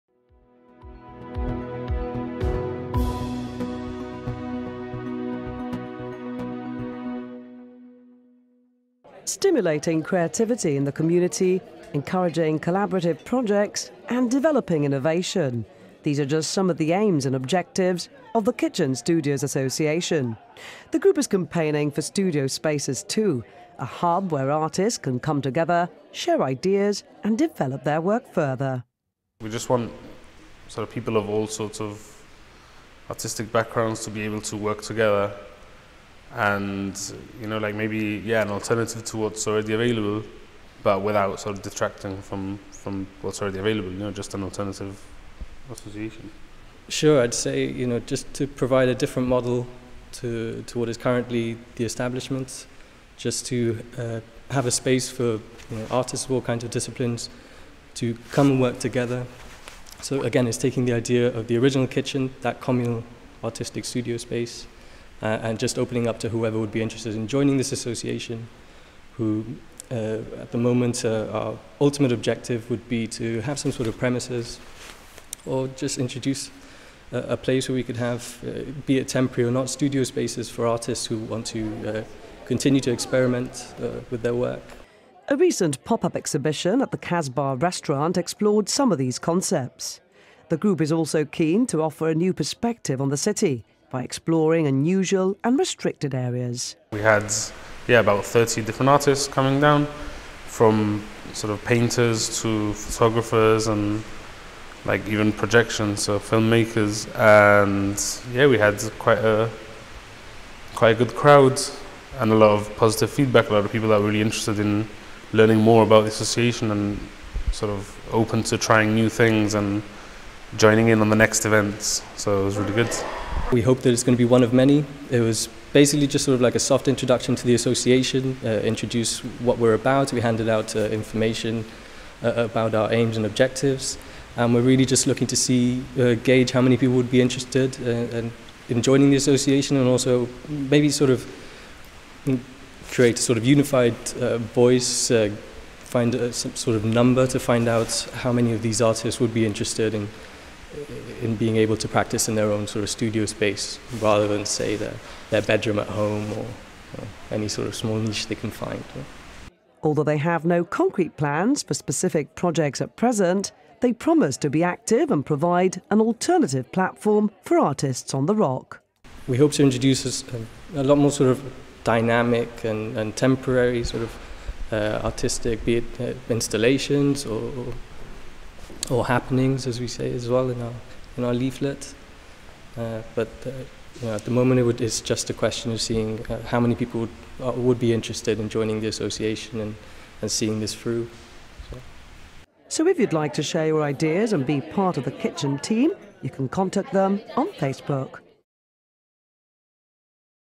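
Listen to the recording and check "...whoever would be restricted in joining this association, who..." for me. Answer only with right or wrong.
wrong.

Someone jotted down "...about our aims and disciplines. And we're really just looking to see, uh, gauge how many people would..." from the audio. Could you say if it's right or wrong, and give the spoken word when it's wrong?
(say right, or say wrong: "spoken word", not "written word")
wrong: "objectives", not "disciplines".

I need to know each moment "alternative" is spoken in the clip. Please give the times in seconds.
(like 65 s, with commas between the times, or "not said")
38 s, 44 s, 166 s.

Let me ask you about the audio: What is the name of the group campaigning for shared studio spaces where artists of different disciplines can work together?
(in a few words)
Kitchen Studios Association.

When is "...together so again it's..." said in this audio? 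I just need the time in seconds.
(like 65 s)
58 s.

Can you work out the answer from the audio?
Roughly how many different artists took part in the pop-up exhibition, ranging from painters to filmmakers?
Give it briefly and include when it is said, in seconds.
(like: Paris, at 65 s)
30, at 98 s.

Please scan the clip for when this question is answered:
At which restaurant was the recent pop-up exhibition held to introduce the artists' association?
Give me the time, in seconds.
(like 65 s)
86 s.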